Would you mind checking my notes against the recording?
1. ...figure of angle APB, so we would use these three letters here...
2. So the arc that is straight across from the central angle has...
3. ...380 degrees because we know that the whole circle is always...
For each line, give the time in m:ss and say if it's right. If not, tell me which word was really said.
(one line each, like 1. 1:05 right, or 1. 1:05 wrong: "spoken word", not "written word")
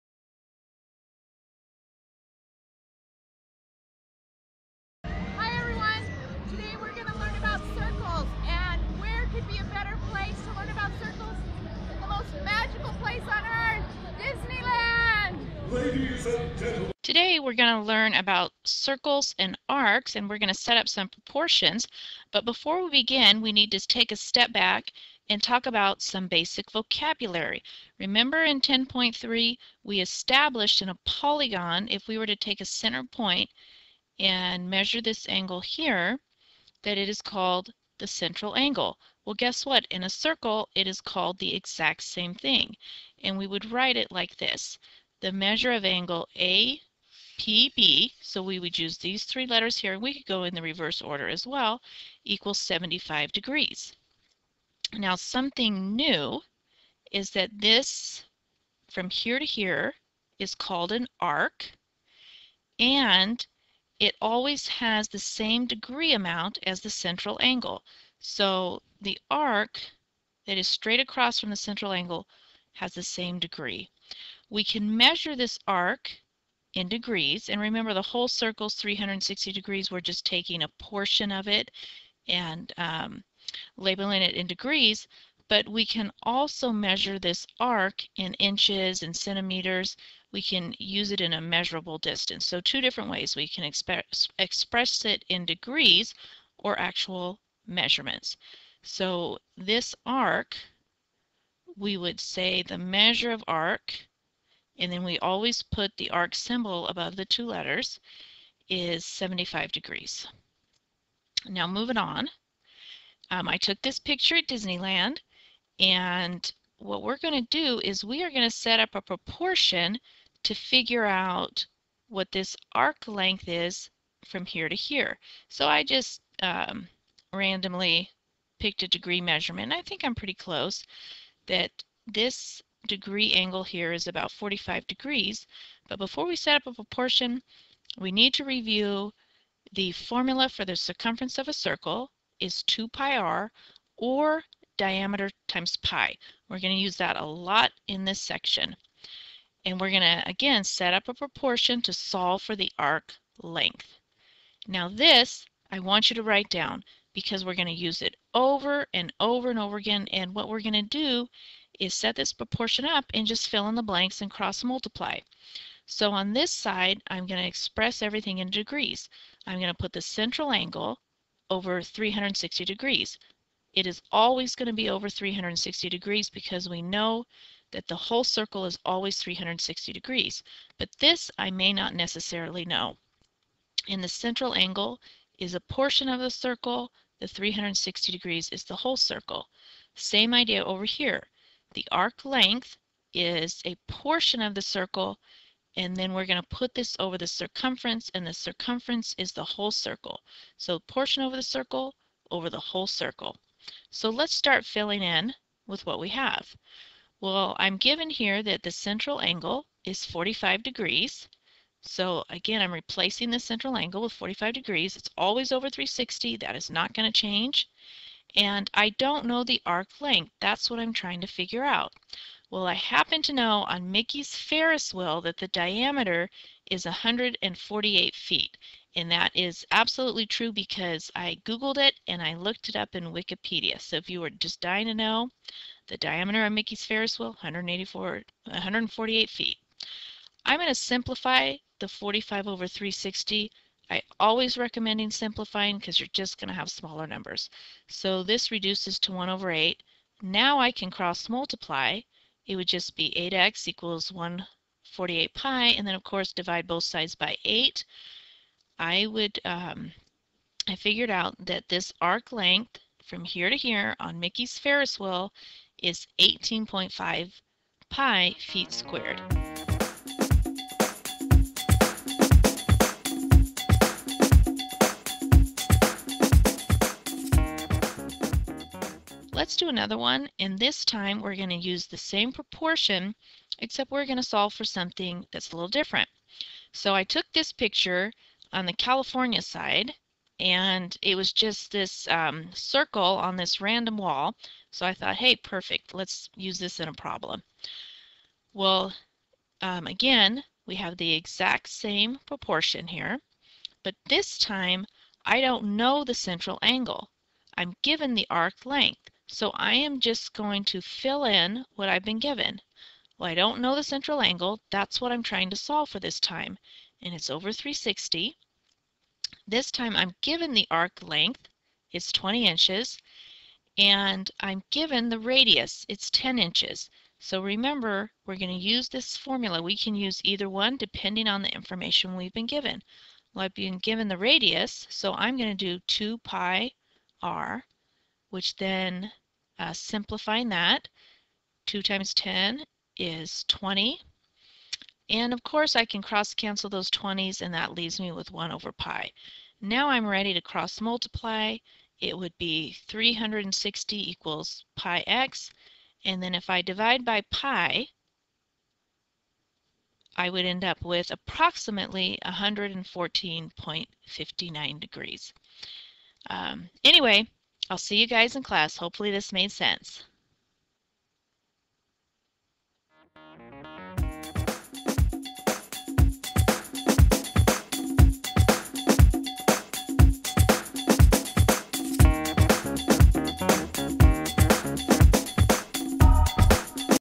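1. 0:45 wrong: "measure", not "figure"
2. 1:08 right
3. 2:55 wrong: "360", not "380".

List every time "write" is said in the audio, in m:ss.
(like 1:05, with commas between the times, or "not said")
0:43, 2:36.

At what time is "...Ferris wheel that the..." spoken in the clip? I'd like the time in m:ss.
3:44.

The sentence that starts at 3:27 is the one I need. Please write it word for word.
Well, I'm given here that the central angle is 45 degrees.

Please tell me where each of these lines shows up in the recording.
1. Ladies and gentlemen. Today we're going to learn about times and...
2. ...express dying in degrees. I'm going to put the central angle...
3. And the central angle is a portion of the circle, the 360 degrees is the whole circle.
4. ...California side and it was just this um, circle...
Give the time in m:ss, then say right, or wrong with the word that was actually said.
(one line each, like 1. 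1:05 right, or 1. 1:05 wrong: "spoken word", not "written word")
1. 0:15 wrong: "circles", not "times"
2. 2:47 wrong: "everything", not "dying"
3. 3:03 right
4. 4:48 right.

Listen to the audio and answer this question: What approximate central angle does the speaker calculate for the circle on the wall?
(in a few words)
114.59 degrees.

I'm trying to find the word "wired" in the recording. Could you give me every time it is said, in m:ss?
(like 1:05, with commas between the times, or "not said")
not said.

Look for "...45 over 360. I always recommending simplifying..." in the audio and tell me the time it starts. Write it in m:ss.
4:01.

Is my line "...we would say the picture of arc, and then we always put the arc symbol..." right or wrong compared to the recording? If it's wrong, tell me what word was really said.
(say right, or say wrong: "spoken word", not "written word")
wrong: "measure", not "picture".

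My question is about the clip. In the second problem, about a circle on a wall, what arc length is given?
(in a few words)
20 inches.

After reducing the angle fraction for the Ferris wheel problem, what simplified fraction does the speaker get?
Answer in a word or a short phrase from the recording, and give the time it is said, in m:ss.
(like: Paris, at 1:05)
1/8, at 4:09.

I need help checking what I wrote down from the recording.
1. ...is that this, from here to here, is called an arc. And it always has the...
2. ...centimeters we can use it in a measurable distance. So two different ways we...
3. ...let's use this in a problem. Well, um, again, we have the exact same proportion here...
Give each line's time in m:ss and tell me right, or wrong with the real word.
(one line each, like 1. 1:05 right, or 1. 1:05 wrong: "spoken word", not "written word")
1. 0:57 right
2. 1:29 right
3. 4:55 right.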